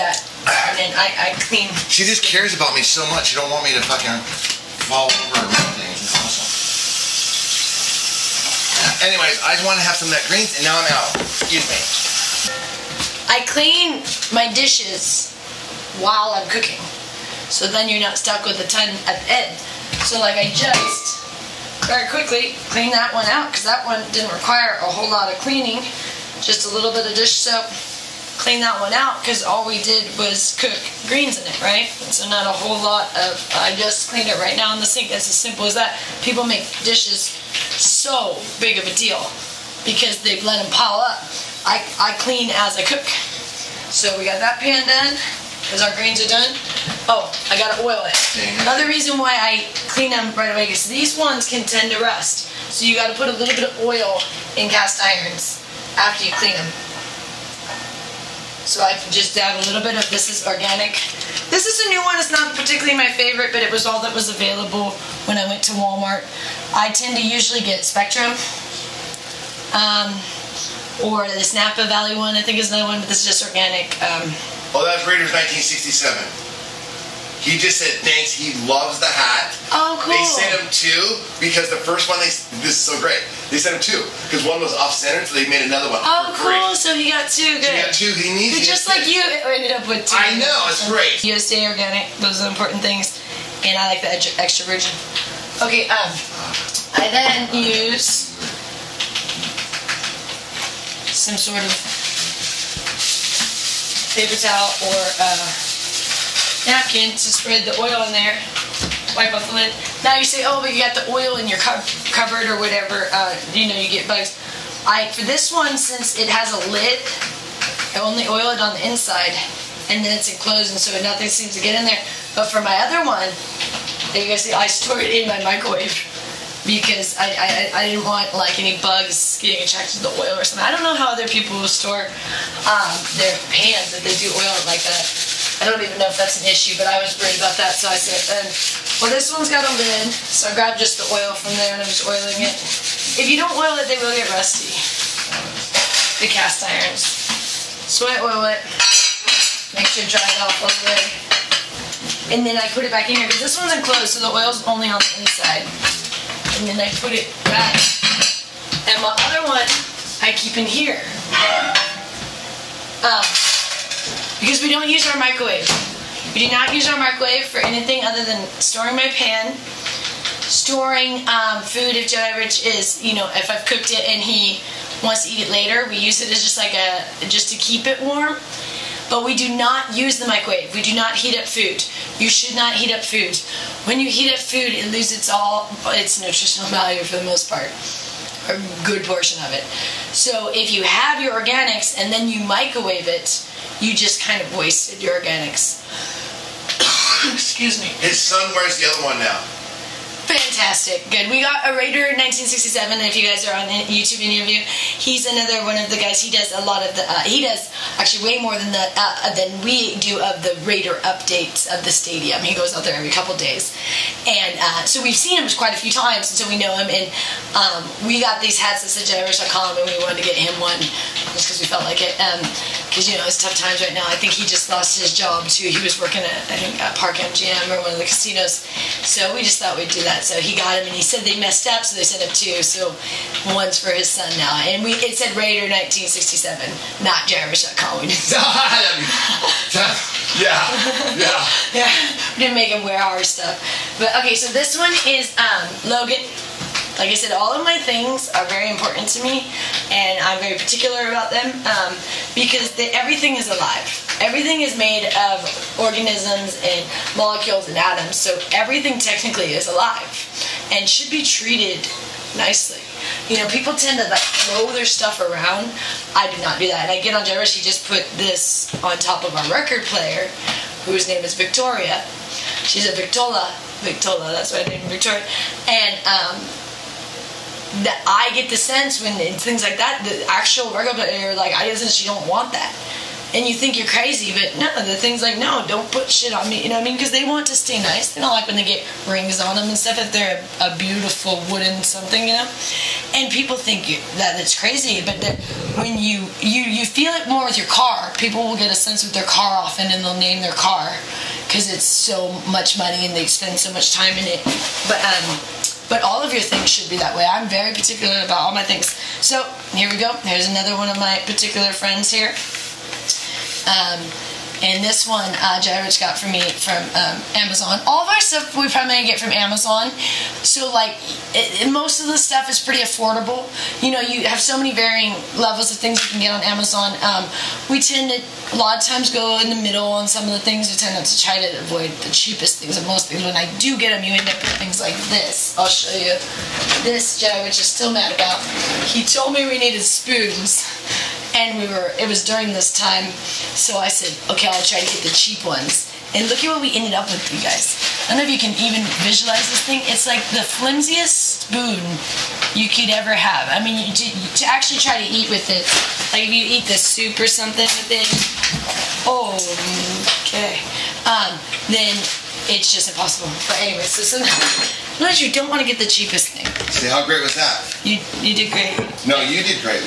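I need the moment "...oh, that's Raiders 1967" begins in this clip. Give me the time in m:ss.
1:14.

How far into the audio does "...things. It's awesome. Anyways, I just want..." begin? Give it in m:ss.
0:05.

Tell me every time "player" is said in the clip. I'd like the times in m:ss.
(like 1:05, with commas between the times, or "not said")
4:29, 4:40.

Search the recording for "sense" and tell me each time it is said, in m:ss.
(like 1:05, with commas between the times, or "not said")
4:38, 4:58.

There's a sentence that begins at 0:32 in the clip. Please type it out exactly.
So not a whole lot of, I just cleaned it right now in the sink.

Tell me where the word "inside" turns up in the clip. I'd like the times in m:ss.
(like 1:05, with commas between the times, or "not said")
1:58, 2:35.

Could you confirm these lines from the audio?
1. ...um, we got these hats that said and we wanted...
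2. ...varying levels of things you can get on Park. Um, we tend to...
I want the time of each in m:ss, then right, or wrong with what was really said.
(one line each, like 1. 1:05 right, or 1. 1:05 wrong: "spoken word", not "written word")
1. 3:37 right
2. 5:24 wrong: "Amazon", not "Park".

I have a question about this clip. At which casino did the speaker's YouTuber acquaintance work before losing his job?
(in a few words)
Park MGM.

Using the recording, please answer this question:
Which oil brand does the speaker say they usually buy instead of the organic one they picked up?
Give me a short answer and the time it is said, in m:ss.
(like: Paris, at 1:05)
Spectrum, at 1:07.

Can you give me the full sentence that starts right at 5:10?
Here's another one of my particular friends here.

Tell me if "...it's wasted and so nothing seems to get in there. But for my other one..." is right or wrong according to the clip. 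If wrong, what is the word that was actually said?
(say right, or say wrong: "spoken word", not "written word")
wrong: "enclosed", not "wasted".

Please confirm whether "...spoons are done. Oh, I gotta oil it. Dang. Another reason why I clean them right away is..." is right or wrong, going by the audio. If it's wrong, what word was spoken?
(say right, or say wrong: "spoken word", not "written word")
wrong: "greens", not "spoons".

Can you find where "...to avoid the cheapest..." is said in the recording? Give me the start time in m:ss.
5:31.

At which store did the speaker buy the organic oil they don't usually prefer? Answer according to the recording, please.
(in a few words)
Walmart.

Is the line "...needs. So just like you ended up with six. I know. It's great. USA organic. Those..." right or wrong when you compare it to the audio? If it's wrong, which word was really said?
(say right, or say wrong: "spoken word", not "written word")
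wrong: "two", not "six".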